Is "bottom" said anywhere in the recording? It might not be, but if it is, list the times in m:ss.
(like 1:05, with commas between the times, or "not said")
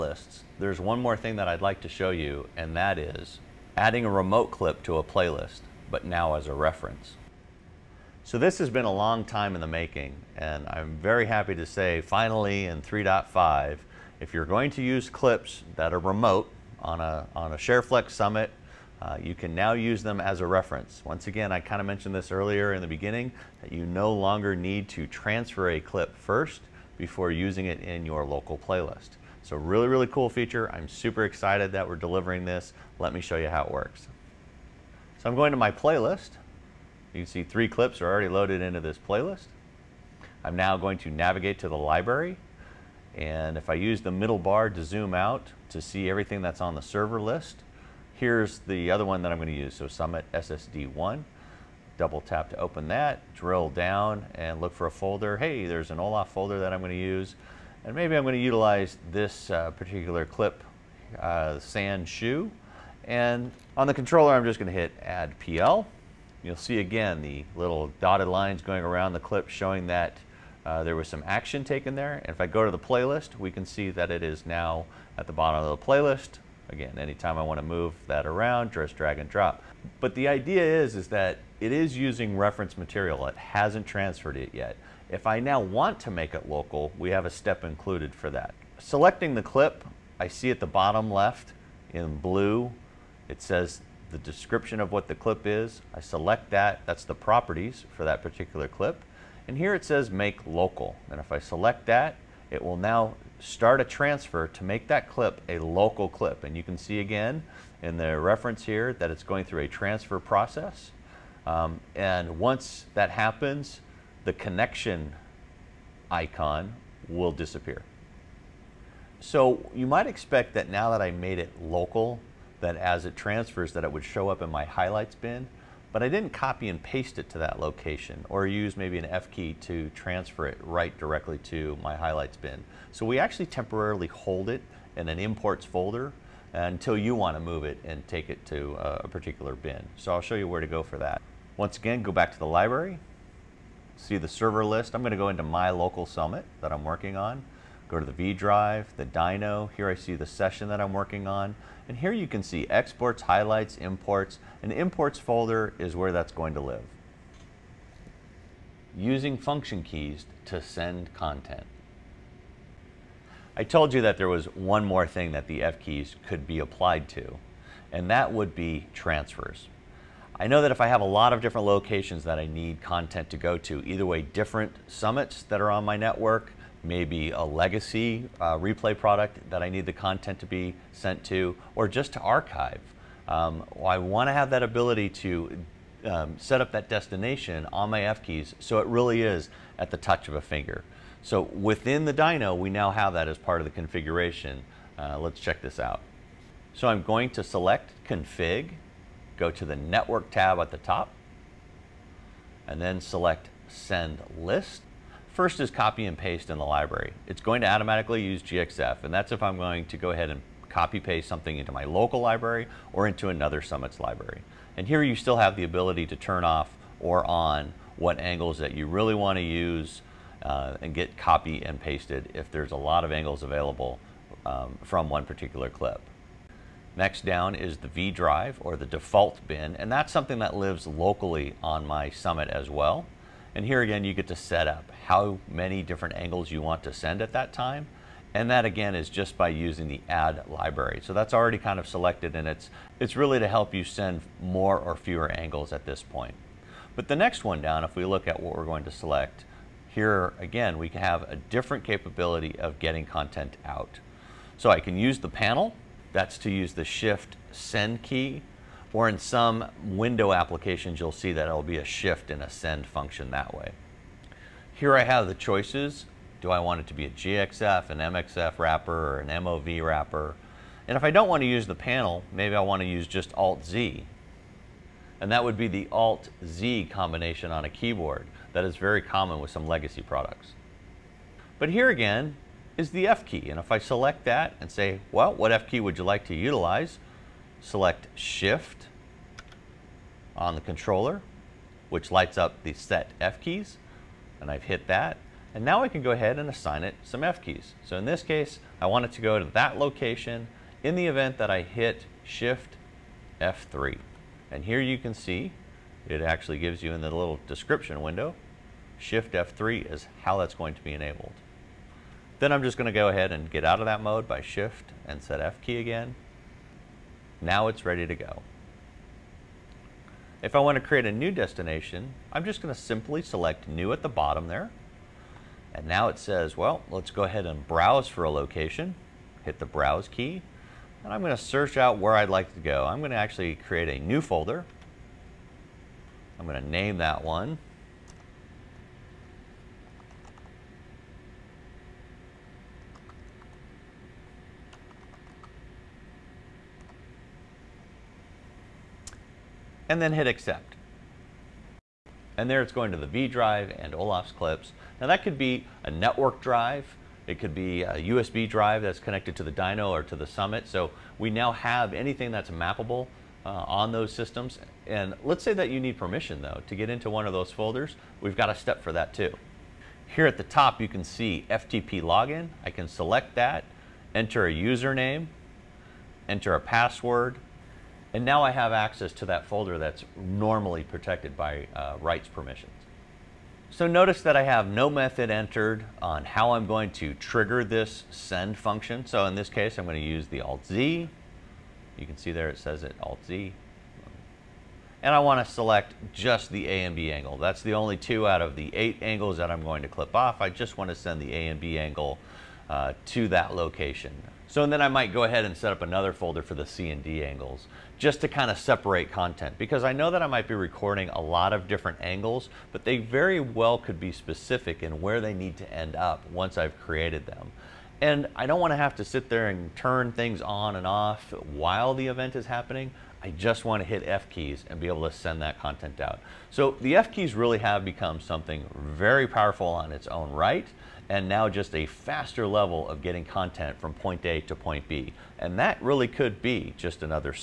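1:15, 1:30, 5:24.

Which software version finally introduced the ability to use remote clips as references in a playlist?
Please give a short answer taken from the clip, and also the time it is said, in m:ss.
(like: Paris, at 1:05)
3.5, at 0:12.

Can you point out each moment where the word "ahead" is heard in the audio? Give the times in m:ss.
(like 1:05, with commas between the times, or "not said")
3:30, 4:56, 5:13, 5:27, 6:45.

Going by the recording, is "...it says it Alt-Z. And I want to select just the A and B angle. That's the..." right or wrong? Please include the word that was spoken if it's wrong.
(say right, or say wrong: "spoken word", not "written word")
right.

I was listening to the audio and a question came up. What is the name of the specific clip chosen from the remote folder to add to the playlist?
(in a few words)
sand shoe.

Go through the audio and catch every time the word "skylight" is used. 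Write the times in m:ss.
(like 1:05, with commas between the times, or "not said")
not said.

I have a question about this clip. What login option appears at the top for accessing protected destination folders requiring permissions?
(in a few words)
FTP login.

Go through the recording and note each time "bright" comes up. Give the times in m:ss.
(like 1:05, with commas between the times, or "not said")
not said.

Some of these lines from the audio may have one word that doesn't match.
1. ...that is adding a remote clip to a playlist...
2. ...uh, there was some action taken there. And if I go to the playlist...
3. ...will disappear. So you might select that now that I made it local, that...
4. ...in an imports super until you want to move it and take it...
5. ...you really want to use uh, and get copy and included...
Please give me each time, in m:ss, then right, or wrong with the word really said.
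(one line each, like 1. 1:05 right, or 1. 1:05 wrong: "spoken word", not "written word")
1. 0:02 right
2. 1:10 right
3. 1:57 wrong: "expect", not "select"
4. 2:14 wrong: "folder", not "super"
5. 3:38 wrong: "pasted", not "included".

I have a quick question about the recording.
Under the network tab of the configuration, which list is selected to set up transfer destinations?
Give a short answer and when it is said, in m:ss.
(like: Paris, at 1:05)
send list, at 3:23.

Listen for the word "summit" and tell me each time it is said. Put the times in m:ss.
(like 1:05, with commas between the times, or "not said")
0:18, 0:49, 2:26, 2:54, 3:33, 3:52, 6:00.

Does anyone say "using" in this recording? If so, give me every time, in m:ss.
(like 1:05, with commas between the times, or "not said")
0:27, 1:21, 2:38, 3:59.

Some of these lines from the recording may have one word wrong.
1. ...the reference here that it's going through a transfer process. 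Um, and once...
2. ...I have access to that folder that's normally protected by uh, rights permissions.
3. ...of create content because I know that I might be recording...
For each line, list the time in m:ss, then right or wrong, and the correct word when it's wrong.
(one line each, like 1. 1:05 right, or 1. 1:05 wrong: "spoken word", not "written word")
1. 1:47 right
2. 6:18 right
3. 6:48 wrong: "separate", not "create".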